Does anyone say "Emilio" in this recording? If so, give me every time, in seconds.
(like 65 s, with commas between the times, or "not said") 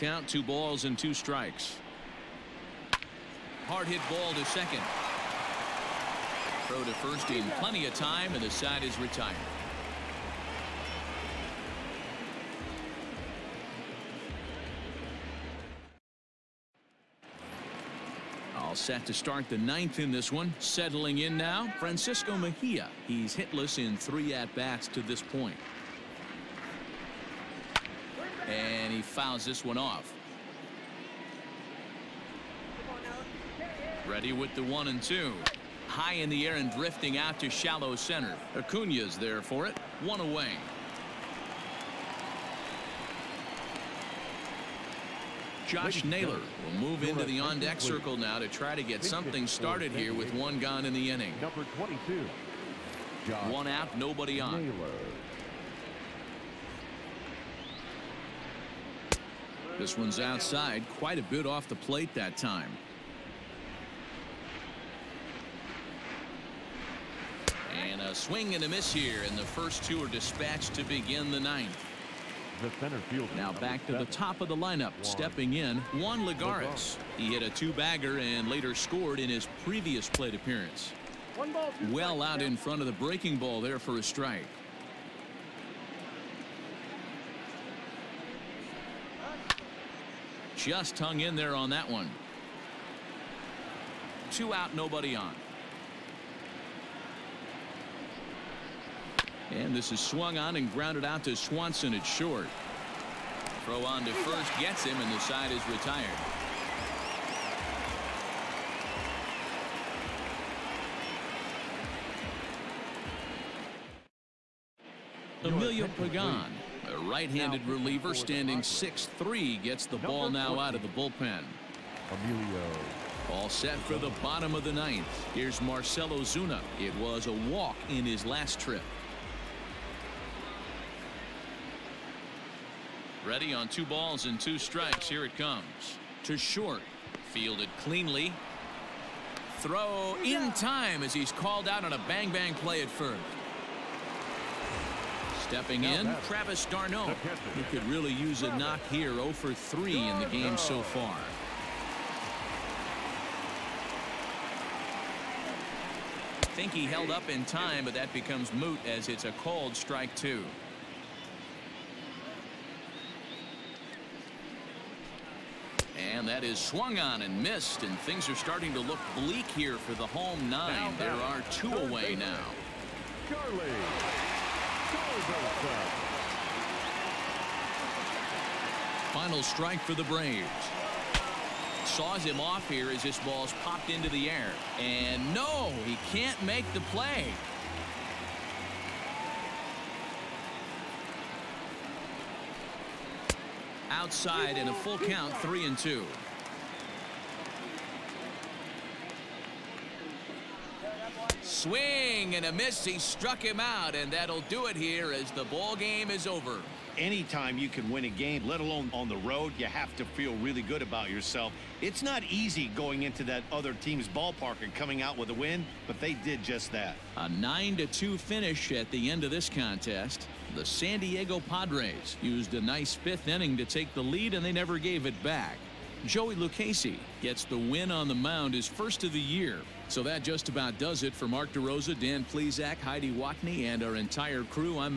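115 s, 122 s.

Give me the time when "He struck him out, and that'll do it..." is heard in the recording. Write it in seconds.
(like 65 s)
202 s.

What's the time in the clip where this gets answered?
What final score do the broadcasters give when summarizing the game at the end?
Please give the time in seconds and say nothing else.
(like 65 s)
217 s.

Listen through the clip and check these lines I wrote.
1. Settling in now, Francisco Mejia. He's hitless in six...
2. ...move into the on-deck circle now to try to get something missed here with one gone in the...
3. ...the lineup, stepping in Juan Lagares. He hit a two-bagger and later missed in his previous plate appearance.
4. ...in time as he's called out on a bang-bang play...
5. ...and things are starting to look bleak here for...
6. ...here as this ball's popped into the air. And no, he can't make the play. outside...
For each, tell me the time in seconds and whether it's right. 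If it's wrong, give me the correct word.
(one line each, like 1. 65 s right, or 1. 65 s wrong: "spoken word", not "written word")
1. 20 s wrong: "three", not "six"
2. 46 s wrong: "started", not "missed"
3. 74 s wrong: "scored", not "missed"
4. 140 s right
5. 167 s right
6. 182 s right.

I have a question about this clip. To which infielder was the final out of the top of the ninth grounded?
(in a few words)
Swanson.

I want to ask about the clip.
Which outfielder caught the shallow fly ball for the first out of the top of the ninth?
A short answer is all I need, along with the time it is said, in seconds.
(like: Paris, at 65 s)
Acuna, at 38 s.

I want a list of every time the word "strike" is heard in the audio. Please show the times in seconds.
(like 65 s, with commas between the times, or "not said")
1 s, 84 s, 134 s, 159 s, 179 s.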